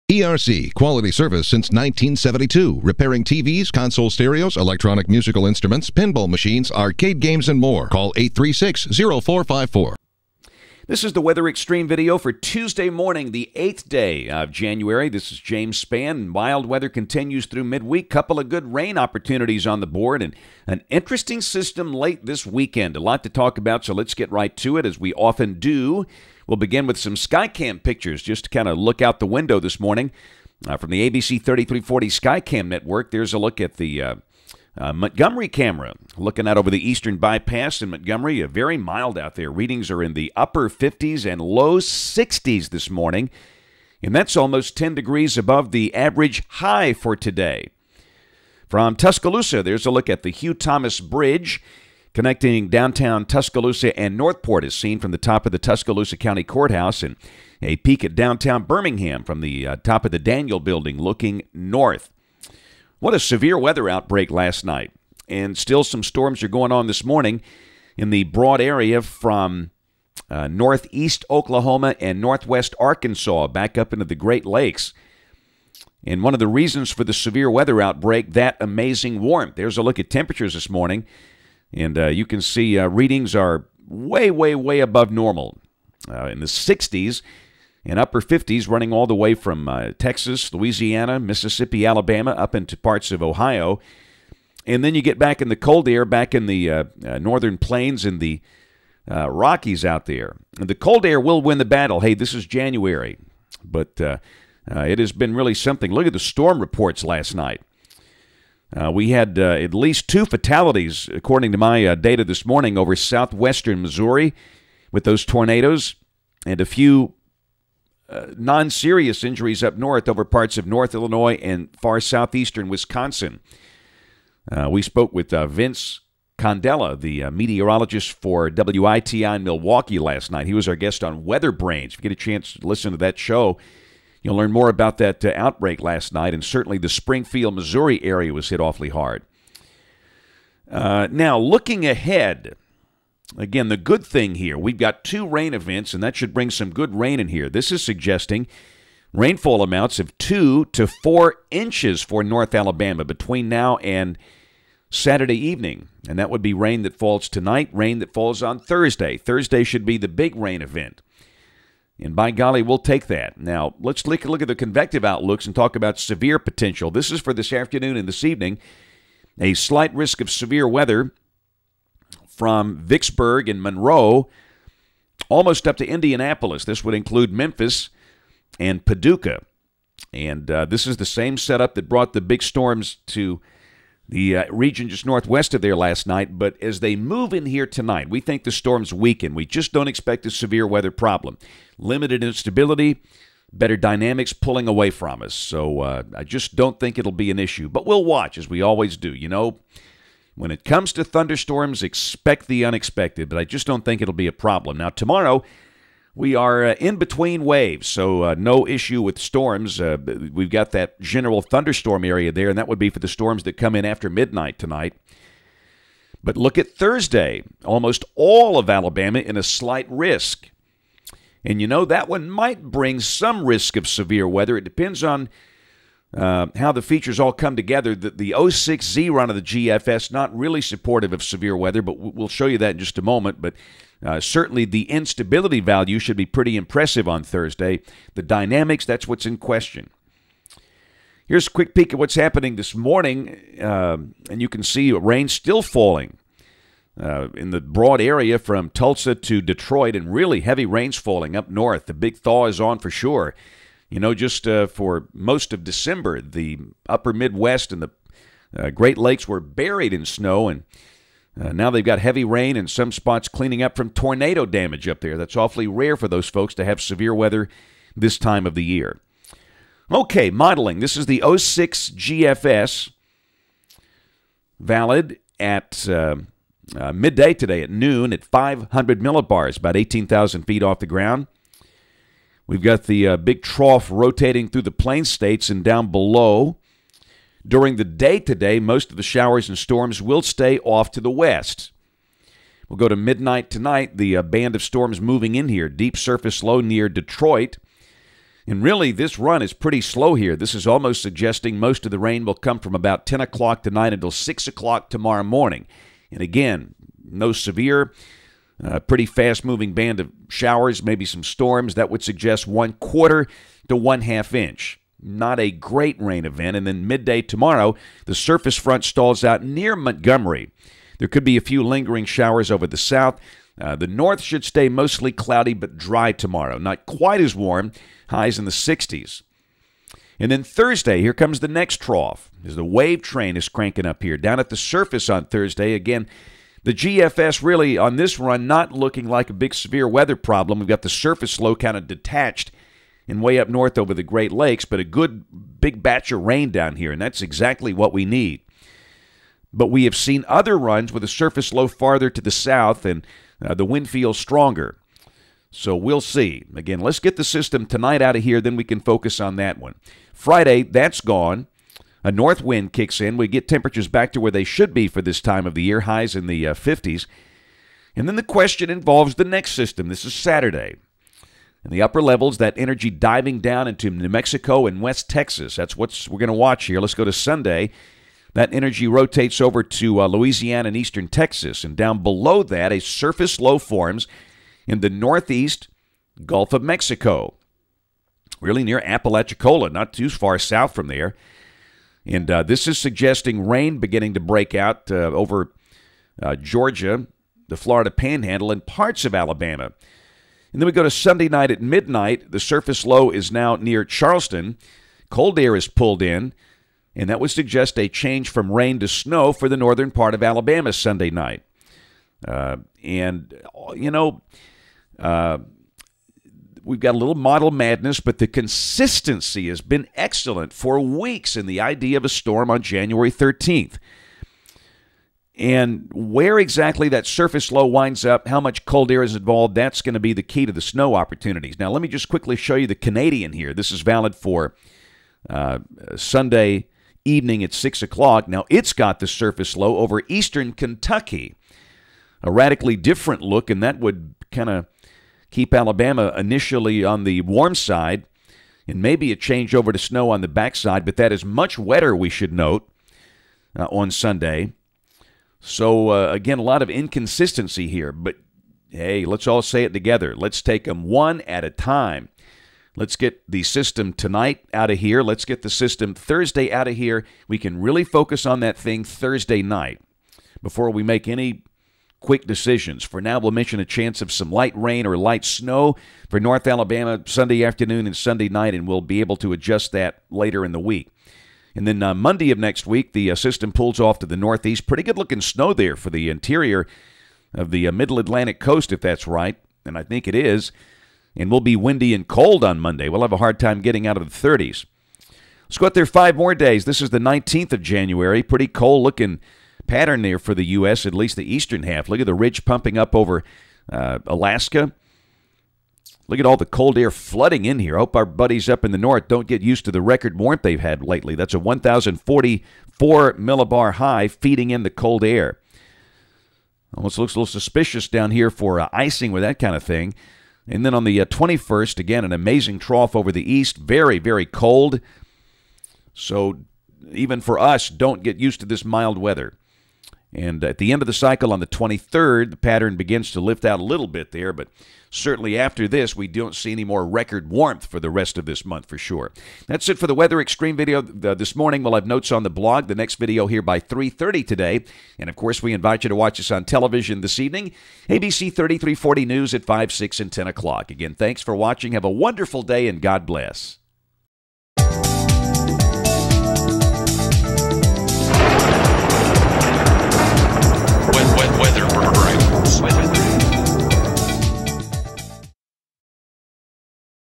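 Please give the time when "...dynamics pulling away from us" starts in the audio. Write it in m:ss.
3:13.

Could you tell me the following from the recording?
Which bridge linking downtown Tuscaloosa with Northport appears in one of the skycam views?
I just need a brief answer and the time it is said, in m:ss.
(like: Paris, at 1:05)
Hugh Thomas Bridge, at 0:50.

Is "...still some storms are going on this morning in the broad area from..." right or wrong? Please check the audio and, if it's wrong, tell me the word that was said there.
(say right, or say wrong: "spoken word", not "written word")
right.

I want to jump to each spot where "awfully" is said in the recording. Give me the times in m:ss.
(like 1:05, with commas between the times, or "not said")
2:18, 4:25.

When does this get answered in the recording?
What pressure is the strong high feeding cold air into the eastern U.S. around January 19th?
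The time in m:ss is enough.
8:31.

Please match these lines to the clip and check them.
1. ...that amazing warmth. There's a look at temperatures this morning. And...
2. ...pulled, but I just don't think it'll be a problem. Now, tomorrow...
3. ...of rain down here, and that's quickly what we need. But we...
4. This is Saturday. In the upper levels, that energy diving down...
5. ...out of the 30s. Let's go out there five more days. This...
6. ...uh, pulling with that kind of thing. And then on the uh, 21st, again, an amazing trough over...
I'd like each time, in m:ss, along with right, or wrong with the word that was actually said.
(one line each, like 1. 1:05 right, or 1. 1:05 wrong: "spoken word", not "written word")
1. 1:18 right
2. 3:22 wrong: "unexpected", not "pulled"
3. 5:46 wrong: "exactly", not "quickly"
4. 6:09 right
5. 8:13 right
6. 8:38 wrong: "icing", not "pulling".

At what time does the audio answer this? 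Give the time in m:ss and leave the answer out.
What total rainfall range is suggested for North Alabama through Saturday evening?
2:30.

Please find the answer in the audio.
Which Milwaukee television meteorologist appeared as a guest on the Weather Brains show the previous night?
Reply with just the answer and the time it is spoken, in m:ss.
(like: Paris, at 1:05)
Vince Condella, at 2:05.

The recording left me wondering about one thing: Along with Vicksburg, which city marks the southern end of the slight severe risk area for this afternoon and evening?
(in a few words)
Monroe.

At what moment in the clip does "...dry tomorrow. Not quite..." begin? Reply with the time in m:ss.
5:25.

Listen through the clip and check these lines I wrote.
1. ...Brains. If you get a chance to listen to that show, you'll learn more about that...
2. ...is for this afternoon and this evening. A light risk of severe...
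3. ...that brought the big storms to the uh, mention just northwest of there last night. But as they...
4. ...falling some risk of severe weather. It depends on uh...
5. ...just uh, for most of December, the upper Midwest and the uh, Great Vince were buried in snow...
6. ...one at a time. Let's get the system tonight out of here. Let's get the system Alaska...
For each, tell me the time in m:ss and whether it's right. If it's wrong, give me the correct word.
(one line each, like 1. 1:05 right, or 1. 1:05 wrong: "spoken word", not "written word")
1. 2:11 right
2. 2:47 wrong: "slight", not "light"
3. 3:01 wrong: "region", not "mention"
4. 3:42 wrong: "bring", not "falling"
5. 4:14 wrong: "Lakes", not "Vince"
6. 7:40 wrong: "Thursday", not "Alaska".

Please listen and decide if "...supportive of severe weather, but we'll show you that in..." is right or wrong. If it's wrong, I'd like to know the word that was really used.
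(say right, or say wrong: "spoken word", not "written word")
right.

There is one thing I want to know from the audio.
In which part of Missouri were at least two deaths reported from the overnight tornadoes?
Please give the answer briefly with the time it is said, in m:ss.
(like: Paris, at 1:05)
southwestern Missouri, at 1:52.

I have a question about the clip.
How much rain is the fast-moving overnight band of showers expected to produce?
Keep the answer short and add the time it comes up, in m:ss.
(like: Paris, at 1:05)
1/4 to 1/2 inch, at 5:12.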